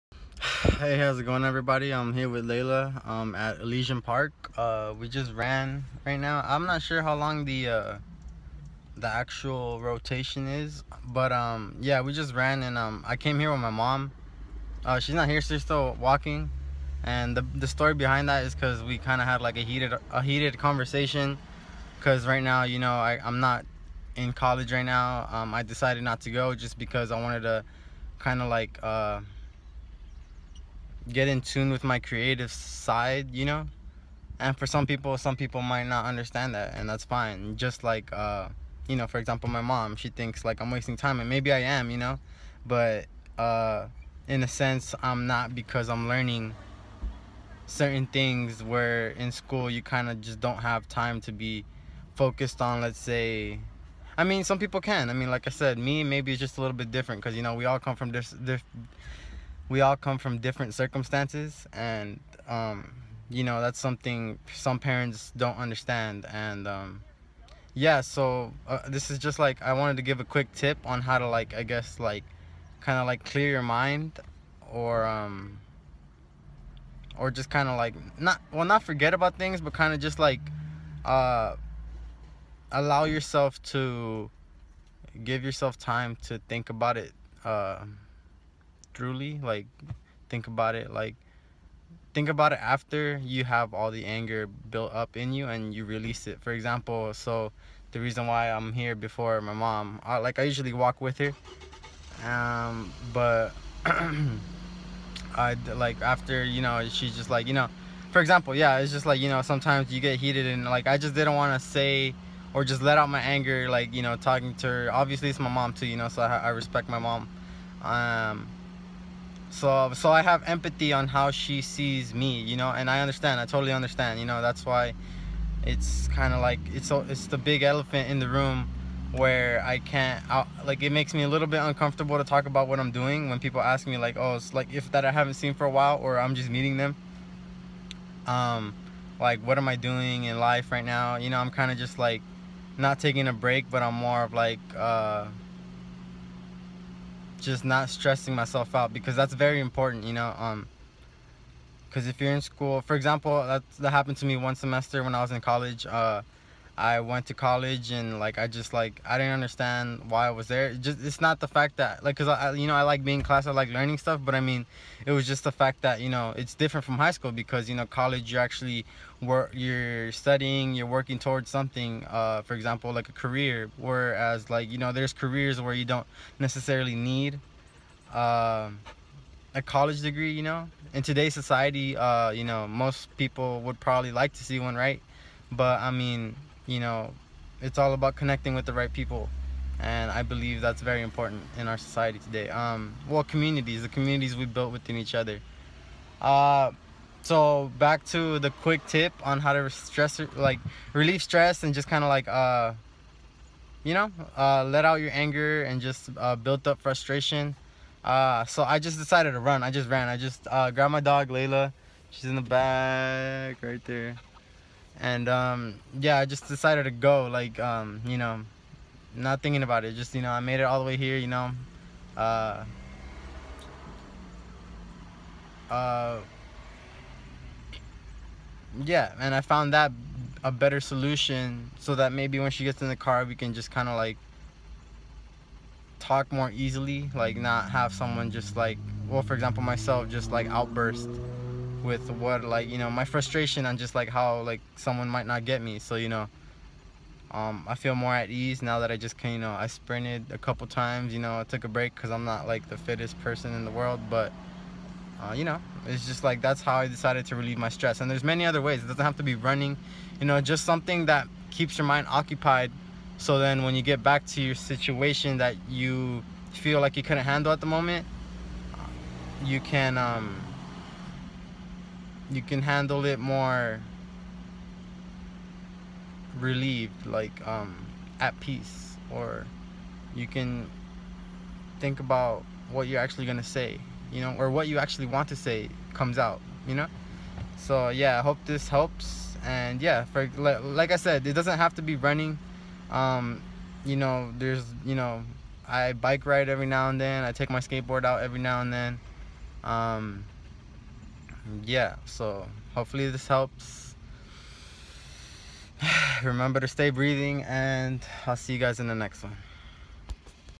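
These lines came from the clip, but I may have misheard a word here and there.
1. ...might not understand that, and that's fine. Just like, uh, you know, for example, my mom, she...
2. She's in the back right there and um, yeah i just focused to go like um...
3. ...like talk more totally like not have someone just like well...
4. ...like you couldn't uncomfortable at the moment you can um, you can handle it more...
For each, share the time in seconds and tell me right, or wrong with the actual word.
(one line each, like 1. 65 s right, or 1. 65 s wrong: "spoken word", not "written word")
1. 35 s right
2. 212 s wrong: "decided", not "focused"
3. 233 s wrong: "easily", not "totally"
4. 266 s wrong: "handle", not "uncomfortable".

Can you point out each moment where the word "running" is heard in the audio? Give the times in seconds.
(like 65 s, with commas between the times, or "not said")
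259 s, 291 s.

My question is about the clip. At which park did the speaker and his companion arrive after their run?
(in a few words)
Elysian Park.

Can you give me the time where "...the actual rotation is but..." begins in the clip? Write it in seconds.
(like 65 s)
8 s.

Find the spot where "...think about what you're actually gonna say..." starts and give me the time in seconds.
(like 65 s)
281 s.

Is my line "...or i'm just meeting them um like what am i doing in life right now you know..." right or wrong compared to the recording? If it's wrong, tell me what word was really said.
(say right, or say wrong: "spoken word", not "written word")
right.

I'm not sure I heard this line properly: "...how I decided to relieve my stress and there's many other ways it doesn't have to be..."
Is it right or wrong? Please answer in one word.
right.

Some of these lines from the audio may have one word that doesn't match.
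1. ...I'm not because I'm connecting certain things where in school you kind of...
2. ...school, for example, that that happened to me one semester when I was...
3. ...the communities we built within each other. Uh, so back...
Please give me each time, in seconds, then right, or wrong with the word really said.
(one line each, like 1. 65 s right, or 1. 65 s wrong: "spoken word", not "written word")
1. 45 s wrong: "learning", not "connecting"
2. 152 s right
3. 193 s right.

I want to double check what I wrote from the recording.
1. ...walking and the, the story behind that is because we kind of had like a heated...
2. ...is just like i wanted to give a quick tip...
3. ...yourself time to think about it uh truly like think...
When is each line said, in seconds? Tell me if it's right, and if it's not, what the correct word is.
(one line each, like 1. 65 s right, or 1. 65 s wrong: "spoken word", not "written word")
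1. 16 s right
2. 69 s right
3. 85 s right.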